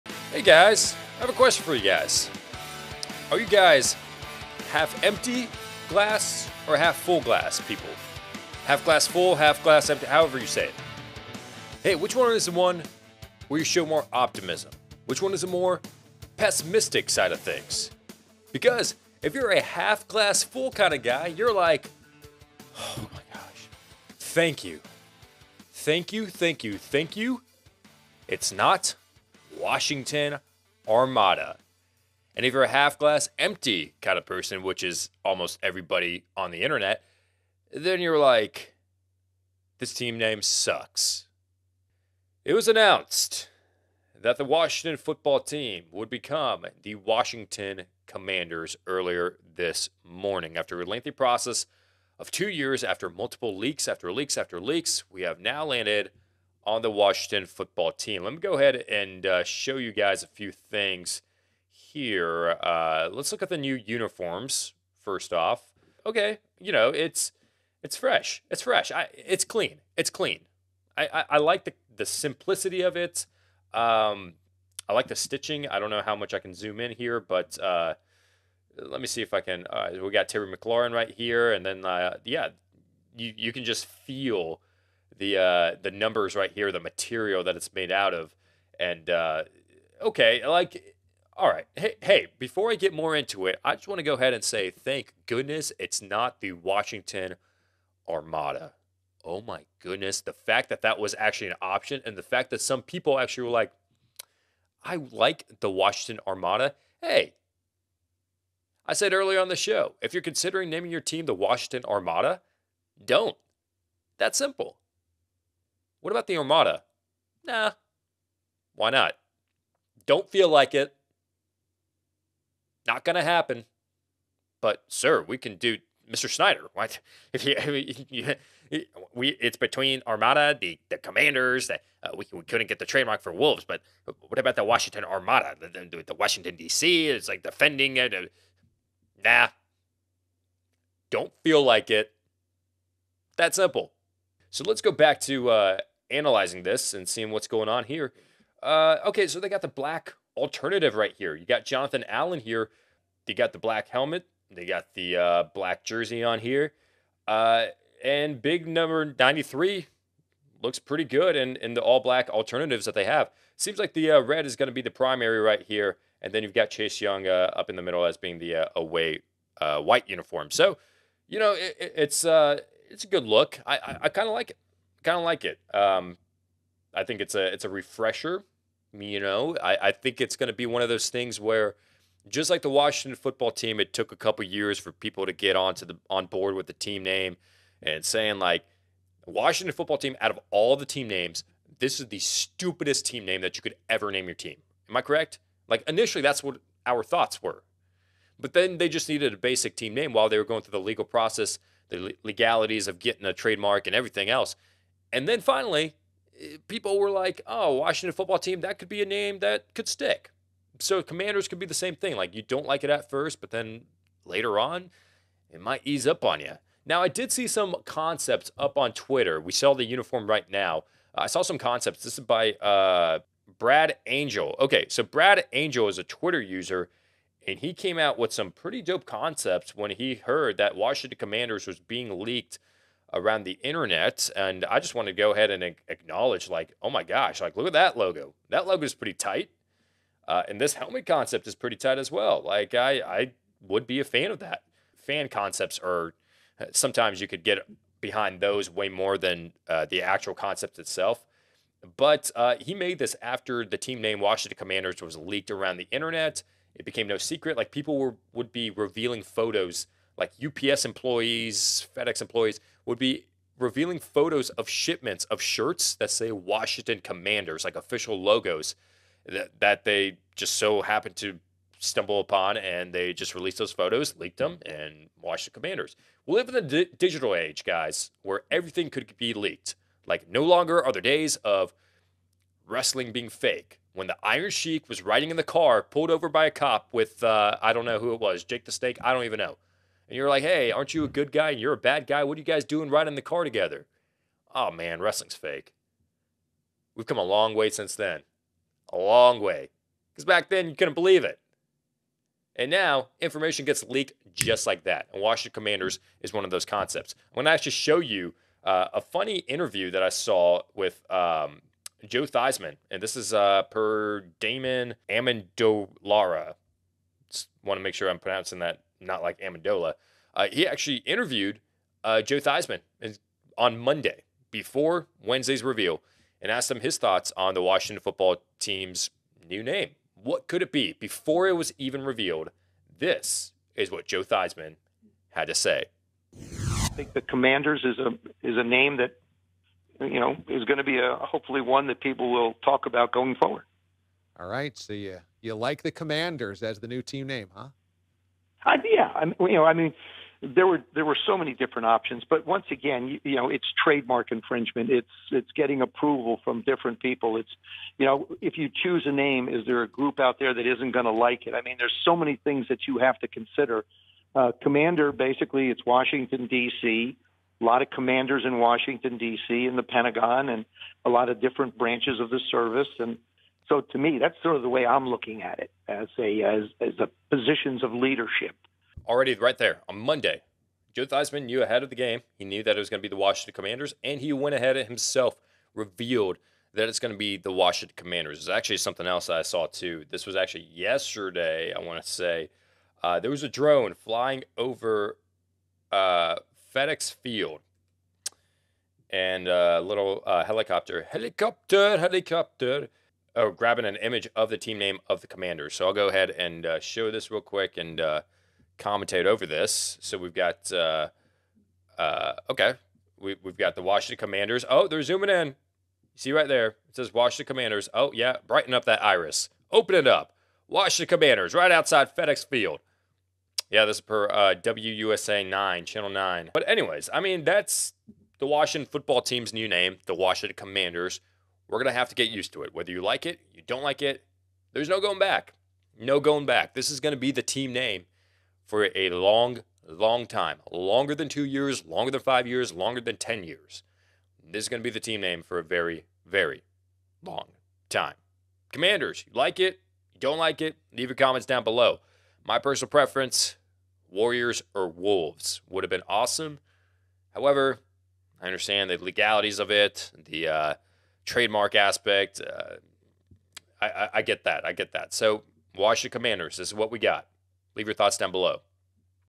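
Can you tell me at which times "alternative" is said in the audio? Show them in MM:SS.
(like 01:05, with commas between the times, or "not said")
02:30, 02:42.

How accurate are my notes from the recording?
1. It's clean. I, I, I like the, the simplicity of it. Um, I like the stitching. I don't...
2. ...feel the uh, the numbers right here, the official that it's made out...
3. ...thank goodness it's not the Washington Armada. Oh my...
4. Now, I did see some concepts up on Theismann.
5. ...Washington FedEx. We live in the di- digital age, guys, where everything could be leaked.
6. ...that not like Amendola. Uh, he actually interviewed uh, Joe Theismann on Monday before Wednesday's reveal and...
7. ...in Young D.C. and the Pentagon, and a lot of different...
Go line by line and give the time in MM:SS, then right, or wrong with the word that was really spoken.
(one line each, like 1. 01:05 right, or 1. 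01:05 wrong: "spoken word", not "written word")
1. 01:09 right
2. 01:23 wrong: "material", not "official"
3. 01:34 right
4. 03:36 wrong: "Twitter", not "Theismann"
5. 04:35 wrong: "Commanders", not "FedEx"
6. 05:18 right
7. 06:08 wrong: "Washington", not "Young".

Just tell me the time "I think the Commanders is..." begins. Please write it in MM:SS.
05:36.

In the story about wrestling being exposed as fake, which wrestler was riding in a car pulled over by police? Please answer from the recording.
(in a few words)
Iron Sheik.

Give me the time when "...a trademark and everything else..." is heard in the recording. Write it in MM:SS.
03:23.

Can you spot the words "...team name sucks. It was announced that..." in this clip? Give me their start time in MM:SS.
00:39.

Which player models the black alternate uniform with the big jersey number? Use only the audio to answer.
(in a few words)
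Jonathan Allen.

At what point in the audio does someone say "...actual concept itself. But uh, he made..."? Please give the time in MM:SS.
04:10.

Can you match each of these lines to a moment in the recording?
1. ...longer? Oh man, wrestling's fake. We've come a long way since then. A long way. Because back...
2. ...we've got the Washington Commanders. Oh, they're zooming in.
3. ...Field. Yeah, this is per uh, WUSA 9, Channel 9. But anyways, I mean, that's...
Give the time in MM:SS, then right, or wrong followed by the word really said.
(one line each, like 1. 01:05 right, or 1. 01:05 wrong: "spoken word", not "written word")
1. 04:53 wrong: "together", not "longer"
2. 06:53 right
3. 07:02 right.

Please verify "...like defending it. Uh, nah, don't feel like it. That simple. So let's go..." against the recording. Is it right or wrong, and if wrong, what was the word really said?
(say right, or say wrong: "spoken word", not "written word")
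right.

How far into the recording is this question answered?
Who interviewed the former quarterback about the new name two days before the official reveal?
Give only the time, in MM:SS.
05:14.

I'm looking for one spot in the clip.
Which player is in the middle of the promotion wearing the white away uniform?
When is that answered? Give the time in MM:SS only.
02:46.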